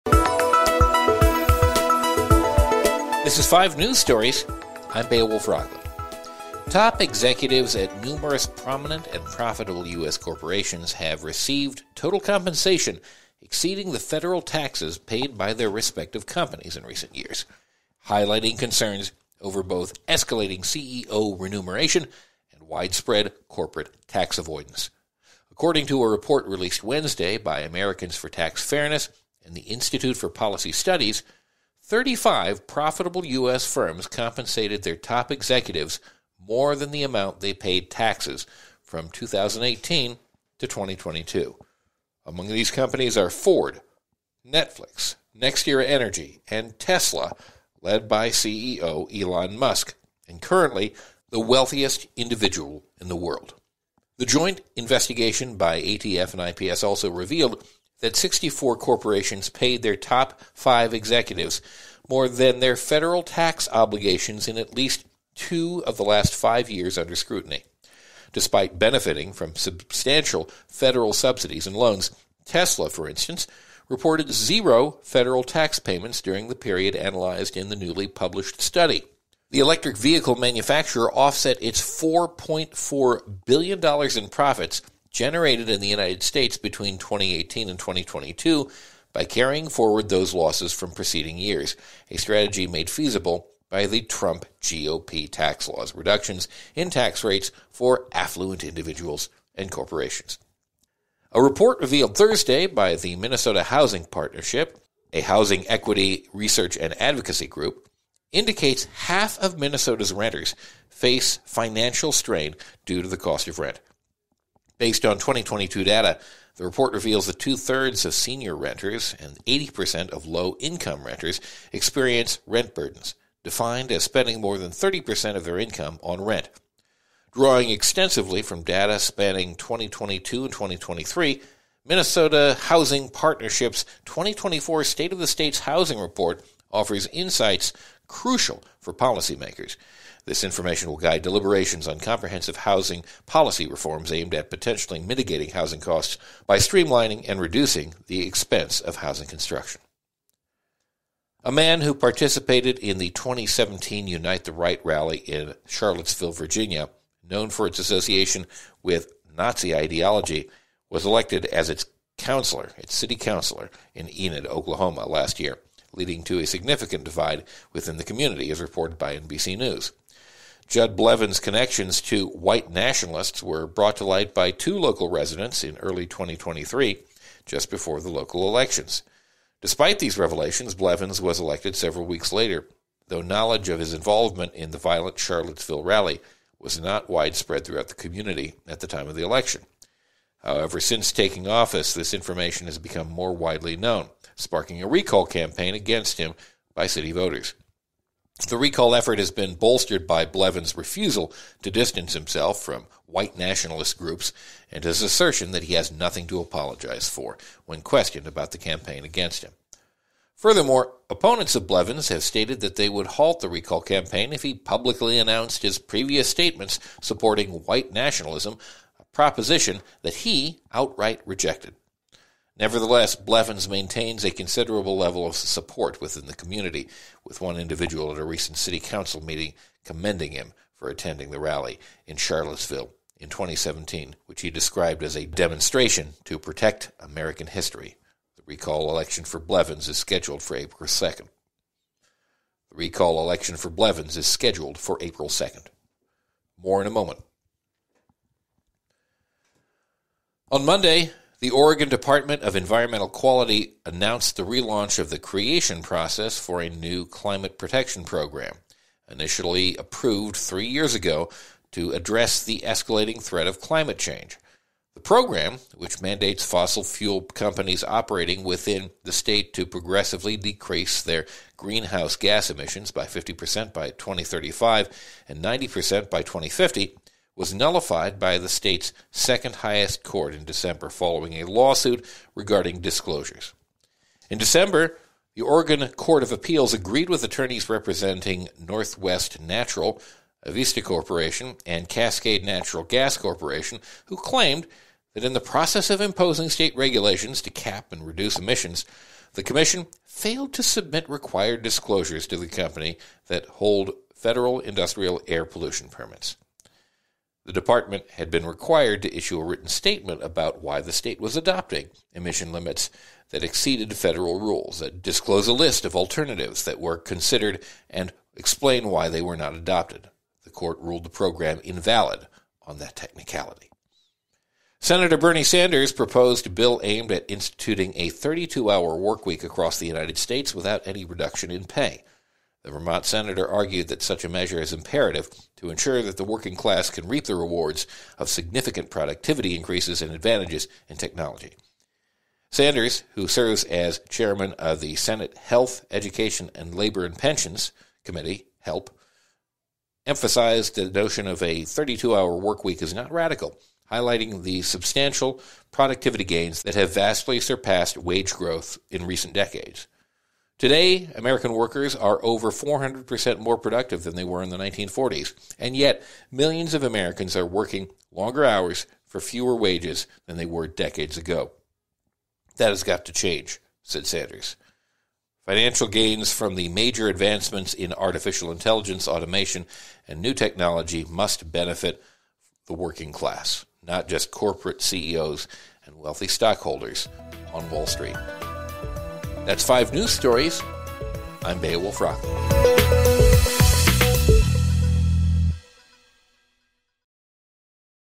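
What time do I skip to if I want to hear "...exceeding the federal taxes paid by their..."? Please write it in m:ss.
0:13.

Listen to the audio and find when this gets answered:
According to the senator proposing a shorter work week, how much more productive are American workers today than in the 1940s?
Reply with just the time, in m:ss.
6:02.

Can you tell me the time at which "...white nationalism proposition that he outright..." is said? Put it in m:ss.
3:37.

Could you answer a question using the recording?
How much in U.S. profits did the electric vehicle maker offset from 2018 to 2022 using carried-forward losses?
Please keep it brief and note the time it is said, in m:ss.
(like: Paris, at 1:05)
$4.4 billion, at 1:21.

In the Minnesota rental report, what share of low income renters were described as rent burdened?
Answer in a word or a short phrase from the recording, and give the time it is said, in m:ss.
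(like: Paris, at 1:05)
80%, at 1:59.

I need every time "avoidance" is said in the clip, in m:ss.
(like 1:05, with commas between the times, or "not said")
0:24.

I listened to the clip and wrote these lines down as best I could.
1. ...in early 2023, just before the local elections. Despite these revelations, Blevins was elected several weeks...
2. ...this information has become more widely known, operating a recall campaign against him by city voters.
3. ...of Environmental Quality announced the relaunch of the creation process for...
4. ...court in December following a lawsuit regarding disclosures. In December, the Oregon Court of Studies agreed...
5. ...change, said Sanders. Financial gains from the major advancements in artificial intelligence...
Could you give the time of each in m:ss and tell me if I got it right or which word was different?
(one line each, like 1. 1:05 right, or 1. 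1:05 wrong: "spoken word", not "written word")
1. 2:55 right
2. 3:11 wrong: "sparking", not "operating"
3. 4:12 right
4. 4:40 wrong: "Appeals", not "Studies"
5. 6:13 right.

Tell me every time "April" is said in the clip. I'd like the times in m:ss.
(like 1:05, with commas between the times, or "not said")
4:00, 4:05.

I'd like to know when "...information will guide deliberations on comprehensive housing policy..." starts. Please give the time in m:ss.
2:20.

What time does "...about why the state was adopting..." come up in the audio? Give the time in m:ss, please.
5:10.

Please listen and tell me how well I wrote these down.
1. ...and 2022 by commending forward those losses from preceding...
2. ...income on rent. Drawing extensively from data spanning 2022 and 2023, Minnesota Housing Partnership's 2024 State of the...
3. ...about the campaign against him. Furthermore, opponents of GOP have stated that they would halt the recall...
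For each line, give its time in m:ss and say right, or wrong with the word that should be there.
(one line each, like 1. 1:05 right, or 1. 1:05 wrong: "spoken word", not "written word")
1. 1:27 wrong: "carrying", not "commending"
2. 2:05 right
3. 3:28 wrong: "Blevins", not "GOP".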